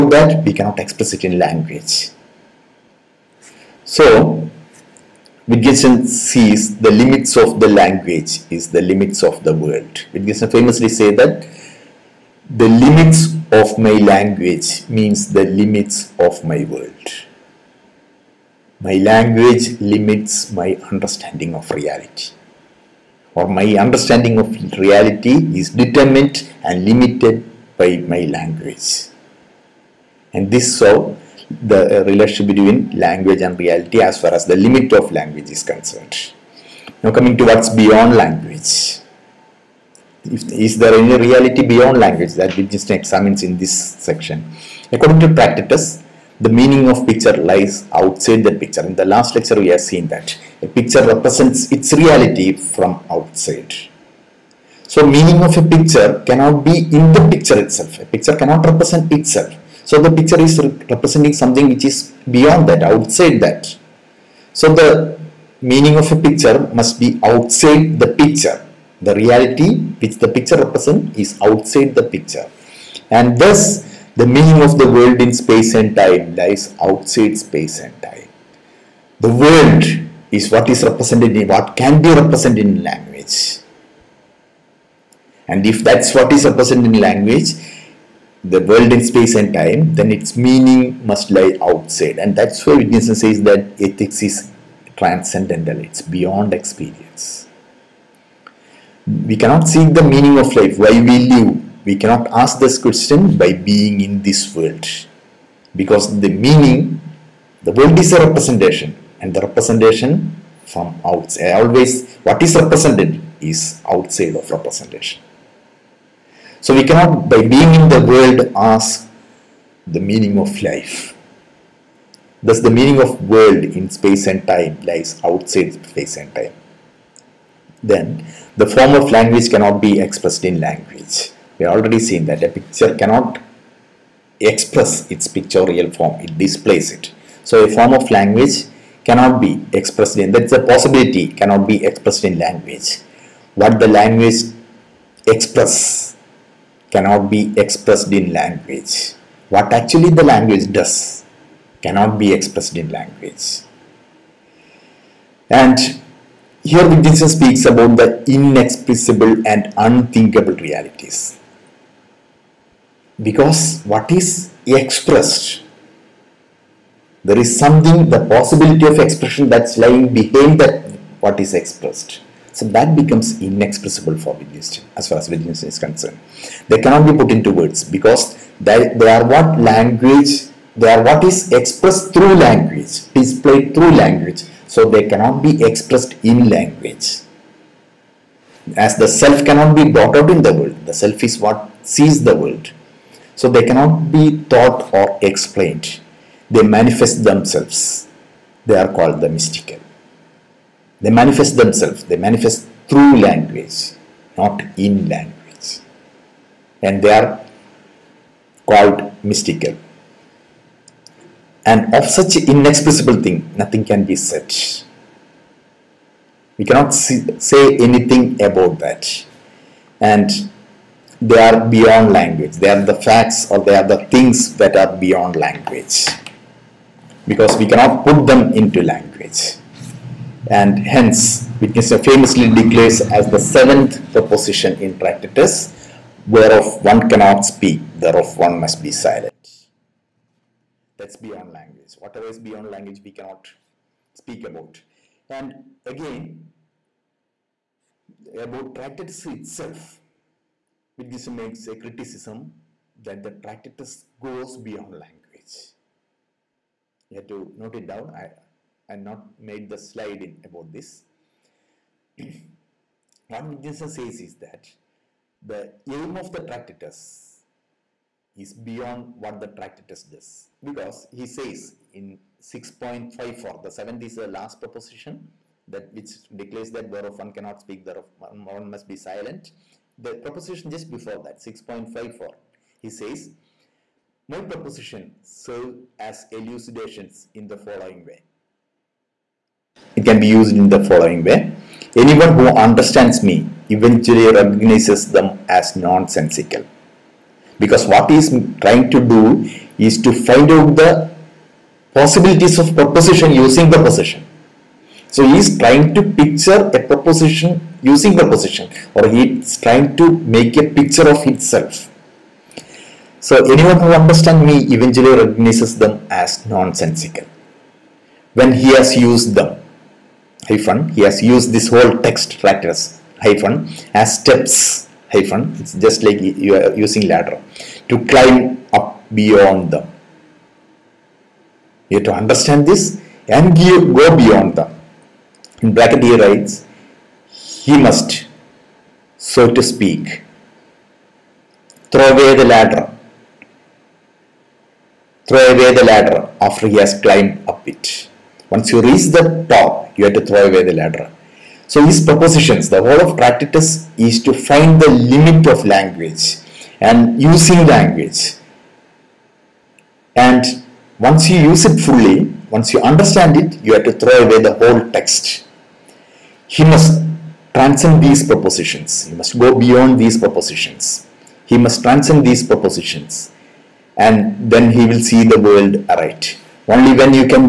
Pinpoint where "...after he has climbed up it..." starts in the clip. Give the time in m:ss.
5:46.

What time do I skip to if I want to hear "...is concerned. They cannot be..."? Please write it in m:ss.
2:55.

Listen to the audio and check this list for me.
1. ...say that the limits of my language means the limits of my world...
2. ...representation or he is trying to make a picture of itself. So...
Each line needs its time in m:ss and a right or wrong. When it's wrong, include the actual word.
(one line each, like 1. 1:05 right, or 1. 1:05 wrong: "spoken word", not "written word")
1. 0:10 right
2. 5:08 wrong: "proposition", not "representation".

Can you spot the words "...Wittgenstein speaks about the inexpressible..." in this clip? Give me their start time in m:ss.
2:36.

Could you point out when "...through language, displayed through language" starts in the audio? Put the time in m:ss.
3:02.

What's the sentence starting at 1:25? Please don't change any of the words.
And if that's what is represented in language, the world in space and time, then its meaning must lie outside.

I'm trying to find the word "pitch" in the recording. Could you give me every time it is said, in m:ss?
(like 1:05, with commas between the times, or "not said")
not said.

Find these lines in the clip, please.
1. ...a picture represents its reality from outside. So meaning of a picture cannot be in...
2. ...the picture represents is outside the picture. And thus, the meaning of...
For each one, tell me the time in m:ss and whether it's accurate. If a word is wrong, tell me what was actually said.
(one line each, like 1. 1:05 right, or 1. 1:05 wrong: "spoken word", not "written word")
1. 0:50 right
2. 1:10 right.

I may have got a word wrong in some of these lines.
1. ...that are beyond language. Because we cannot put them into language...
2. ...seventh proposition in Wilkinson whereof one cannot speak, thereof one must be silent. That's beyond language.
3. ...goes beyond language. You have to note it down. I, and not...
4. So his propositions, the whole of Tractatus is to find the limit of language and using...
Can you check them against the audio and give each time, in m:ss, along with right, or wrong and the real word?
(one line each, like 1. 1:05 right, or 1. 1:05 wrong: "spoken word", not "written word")
1. 3:44 right
2. 3:53 wrong: "Tractatus", not "Wilkinson"
3. 4:14 right
4. 5:51 right.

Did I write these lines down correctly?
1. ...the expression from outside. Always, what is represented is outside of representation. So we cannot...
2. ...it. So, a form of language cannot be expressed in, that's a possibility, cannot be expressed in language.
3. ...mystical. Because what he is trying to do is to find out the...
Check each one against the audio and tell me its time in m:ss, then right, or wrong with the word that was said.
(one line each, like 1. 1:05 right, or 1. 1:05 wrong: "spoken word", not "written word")
1. 1:49 wrong: "representation", not "expression"
2. 2:16 right
3. 4:55 wrong: "nonsensical", not "mystical".